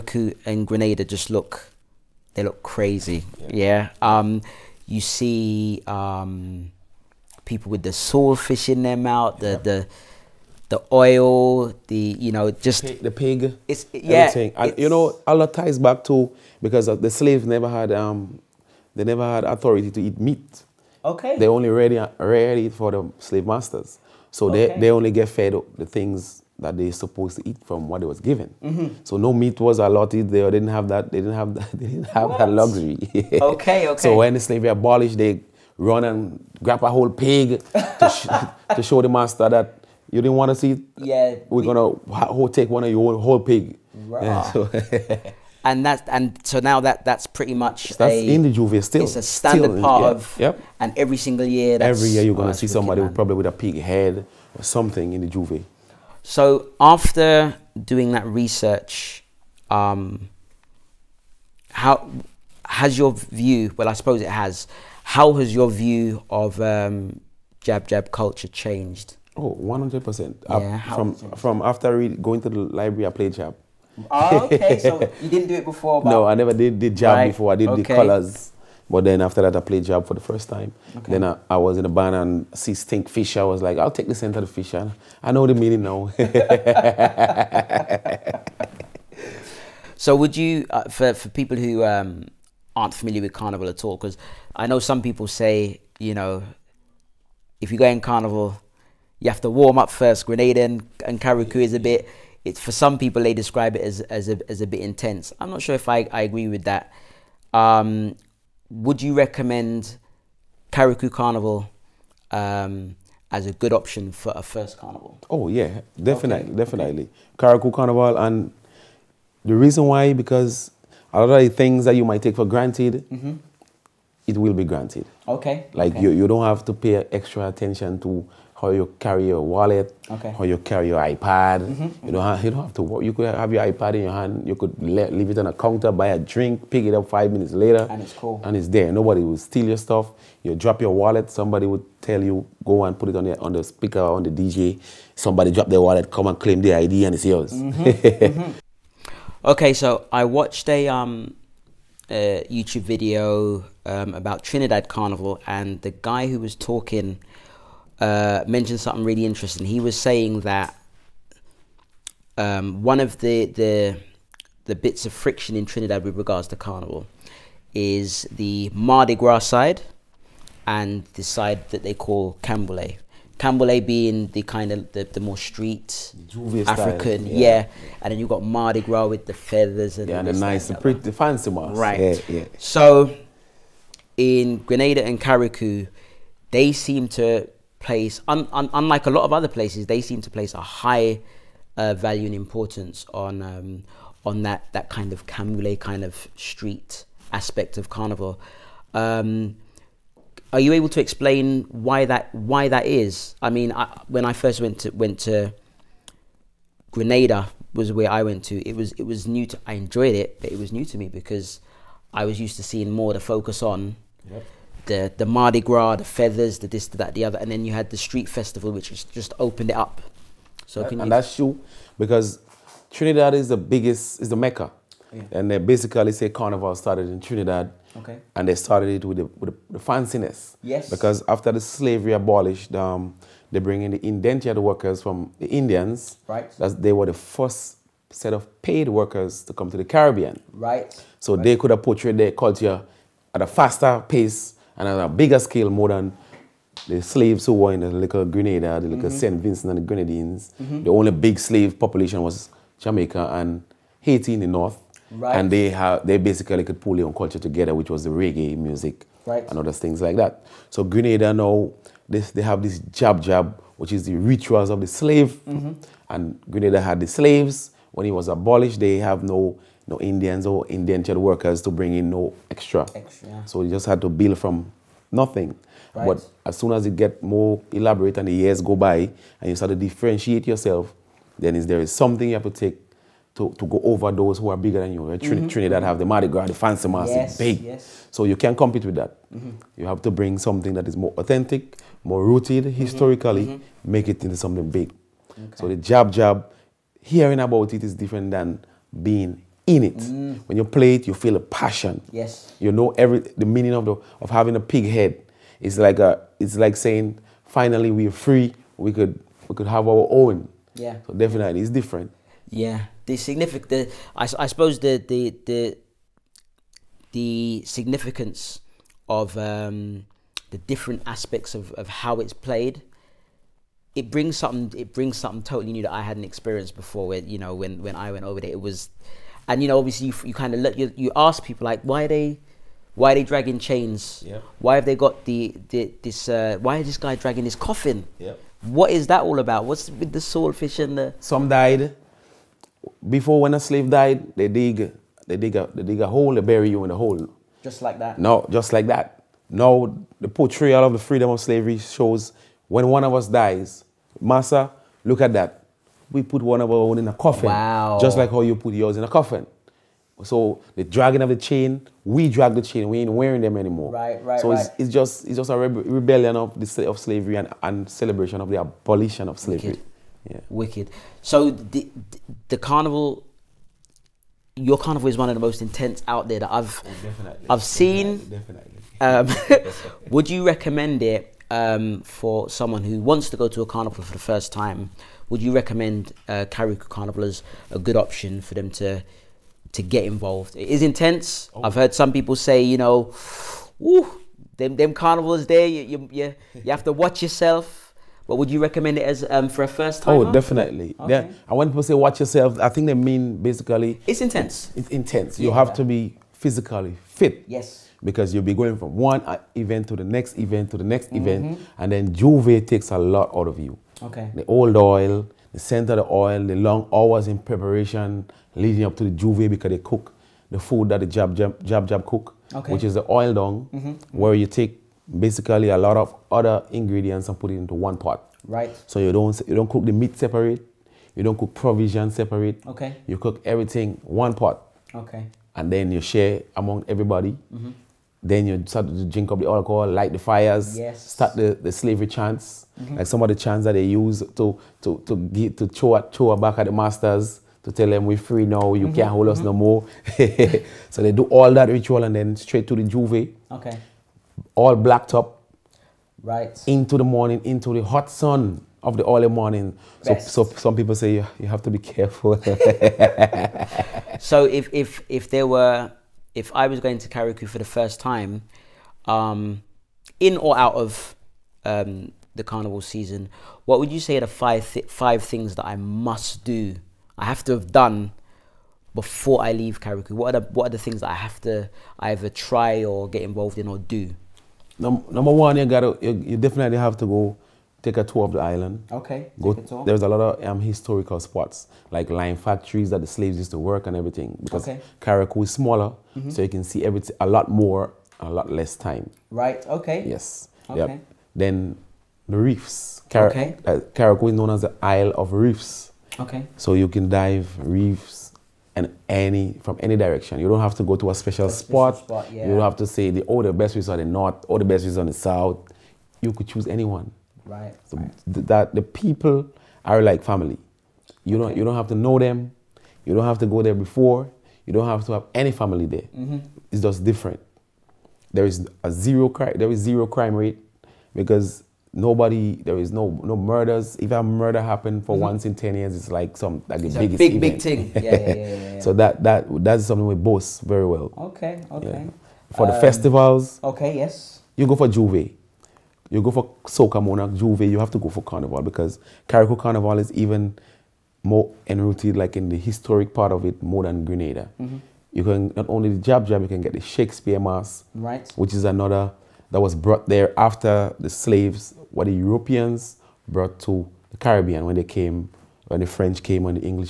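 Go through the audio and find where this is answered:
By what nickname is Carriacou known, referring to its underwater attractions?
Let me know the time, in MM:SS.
08:24.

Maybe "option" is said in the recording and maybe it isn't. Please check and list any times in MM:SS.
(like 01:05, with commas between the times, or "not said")
01:53, 06:27.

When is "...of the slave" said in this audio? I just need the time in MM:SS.
04:24.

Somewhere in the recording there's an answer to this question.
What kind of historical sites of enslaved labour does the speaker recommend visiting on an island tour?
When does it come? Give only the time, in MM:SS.
08:12.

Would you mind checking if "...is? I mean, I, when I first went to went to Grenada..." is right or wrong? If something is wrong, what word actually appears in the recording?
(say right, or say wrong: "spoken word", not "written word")
right.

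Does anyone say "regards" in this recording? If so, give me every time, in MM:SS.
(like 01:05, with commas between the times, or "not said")
02:46.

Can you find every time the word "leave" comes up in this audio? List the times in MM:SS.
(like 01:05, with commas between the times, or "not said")
02:14, 07:59.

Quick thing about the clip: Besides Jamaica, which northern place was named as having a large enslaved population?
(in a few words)
Haiti.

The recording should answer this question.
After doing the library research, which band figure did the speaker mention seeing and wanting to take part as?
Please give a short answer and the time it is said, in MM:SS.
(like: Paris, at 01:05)
Stink Fisher, at 01:22.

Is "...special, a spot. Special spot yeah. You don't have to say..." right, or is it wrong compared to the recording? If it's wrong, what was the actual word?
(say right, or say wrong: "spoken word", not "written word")
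right.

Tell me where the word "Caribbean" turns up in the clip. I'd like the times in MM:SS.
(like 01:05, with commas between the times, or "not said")
03:59, 09:24.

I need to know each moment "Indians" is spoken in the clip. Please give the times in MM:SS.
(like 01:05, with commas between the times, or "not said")
03:55, 04:29.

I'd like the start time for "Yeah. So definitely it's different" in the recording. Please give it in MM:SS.
05:10.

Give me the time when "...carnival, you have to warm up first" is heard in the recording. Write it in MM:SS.
01:38.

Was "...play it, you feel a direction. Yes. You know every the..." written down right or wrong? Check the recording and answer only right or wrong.
wrong.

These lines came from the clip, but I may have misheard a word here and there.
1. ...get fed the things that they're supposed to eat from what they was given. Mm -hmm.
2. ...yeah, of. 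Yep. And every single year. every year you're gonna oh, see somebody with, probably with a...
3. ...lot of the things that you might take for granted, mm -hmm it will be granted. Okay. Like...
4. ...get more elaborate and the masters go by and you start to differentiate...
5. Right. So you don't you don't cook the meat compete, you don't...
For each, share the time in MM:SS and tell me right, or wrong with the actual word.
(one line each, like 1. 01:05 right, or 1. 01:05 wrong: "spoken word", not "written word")
1. 00:25 right
2. 00:50 right
3. 02:01 right
4. 04:36 wrong: "years", not "masters"
5. 07:08 wrong: "separate", not "compete".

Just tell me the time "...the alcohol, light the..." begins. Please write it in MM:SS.
07:19.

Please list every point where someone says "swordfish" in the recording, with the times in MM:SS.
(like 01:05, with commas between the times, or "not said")
00:07, 05:40.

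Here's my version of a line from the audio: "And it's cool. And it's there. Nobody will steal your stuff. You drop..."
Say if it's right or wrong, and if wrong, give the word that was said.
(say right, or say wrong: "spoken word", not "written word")
right.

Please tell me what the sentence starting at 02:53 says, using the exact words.
Canboulay being the kind of the, the more street African, style, yeah.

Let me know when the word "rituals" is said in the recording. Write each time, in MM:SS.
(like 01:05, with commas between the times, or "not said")
04:24, 07:31.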